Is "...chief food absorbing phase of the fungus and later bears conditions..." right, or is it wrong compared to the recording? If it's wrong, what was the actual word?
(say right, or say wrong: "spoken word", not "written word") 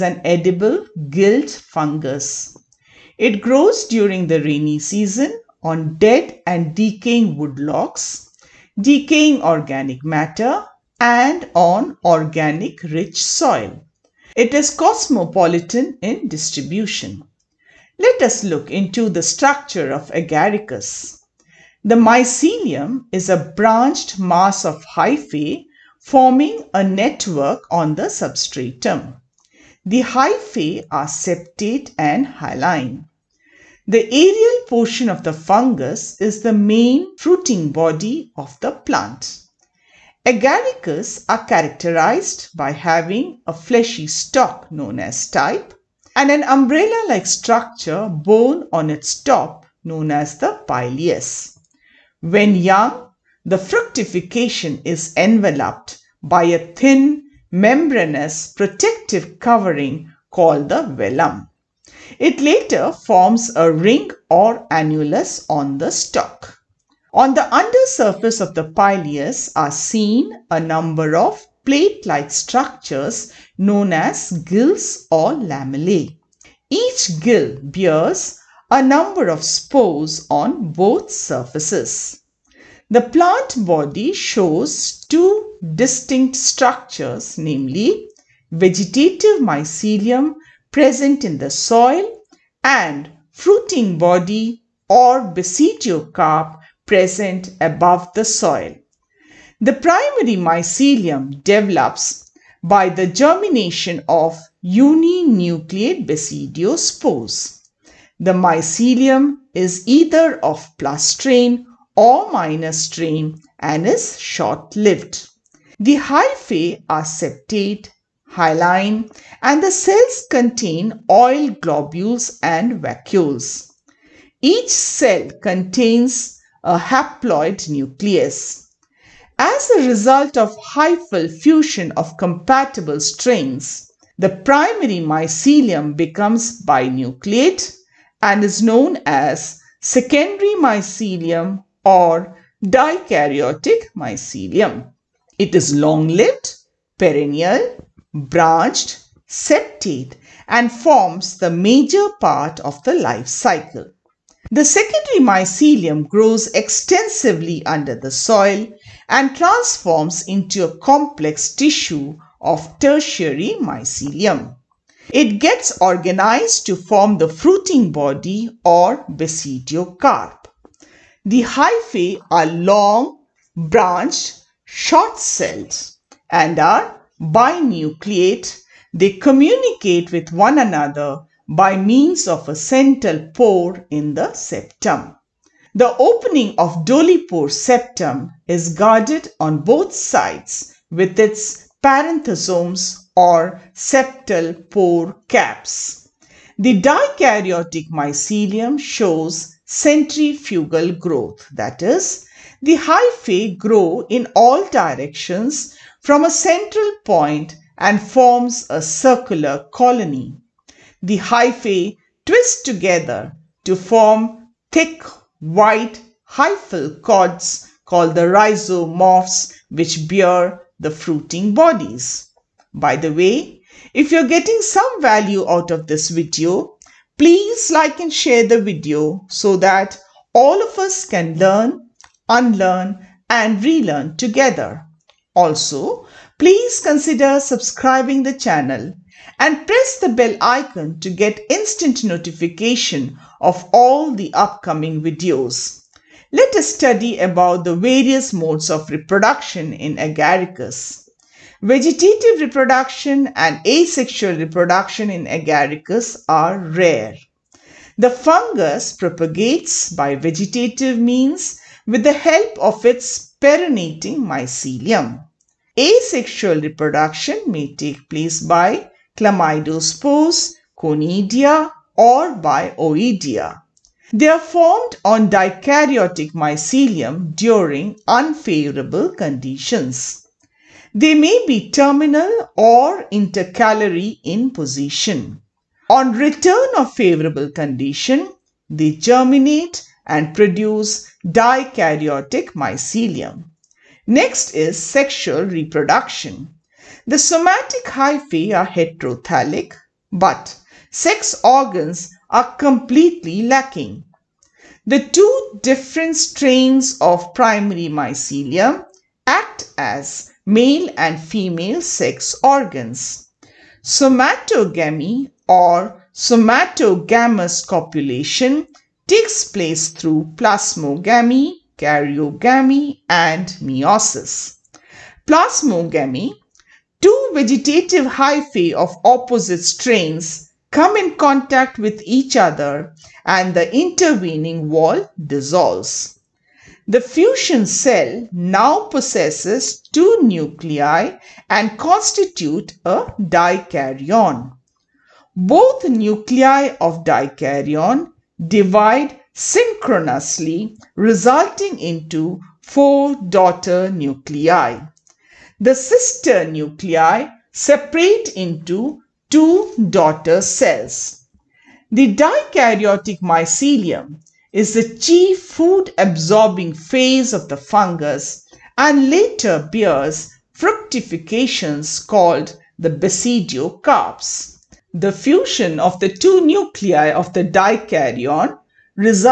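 wrong: "fructifications", not "conditions".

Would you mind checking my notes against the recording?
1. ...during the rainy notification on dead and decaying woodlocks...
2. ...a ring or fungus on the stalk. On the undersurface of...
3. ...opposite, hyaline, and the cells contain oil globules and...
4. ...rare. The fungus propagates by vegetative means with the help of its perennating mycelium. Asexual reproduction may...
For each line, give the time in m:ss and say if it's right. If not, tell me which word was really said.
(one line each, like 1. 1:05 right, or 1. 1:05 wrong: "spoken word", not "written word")
1. 0:03 wrong: "season", not "notification"
2. 1:03 wrong: "annulus", not "fungus"
3. 1:57 wrong: "septate", not "opposite"
4. 4:16 right.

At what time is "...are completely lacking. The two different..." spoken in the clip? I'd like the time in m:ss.
5:02.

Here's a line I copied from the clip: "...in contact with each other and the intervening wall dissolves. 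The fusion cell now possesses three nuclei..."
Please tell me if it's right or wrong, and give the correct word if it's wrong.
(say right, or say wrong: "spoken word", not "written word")
wrong: "two", not "three".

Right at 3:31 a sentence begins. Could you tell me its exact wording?
The hyphae twist together to form thick white hyphal cords called the rhizomorphs which bear the fruiting bodies.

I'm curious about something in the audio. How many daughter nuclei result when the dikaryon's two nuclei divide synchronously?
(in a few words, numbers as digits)
4.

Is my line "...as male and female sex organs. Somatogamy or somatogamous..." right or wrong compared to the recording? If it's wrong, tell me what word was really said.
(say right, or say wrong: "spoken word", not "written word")
right.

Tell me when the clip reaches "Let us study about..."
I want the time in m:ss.
4:06.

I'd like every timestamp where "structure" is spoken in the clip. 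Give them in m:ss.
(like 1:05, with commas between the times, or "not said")
0:19, 0:47, 1:12, 1:26.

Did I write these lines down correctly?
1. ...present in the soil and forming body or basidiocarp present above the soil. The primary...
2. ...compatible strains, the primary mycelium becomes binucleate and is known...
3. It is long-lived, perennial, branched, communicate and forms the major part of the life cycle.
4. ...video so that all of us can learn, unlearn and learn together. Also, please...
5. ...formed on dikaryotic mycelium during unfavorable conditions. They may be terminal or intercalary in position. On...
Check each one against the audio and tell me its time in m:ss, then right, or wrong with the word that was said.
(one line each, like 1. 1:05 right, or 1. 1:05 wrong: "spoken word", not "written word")
1. 1:30 wrong: "fruiting", not "forming"
2. 2:12 right
3. 2:25 wrong: "septate", not "communicate"
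4. 3:48 wrong: "relearn", not "learn"
5. 4:34 right.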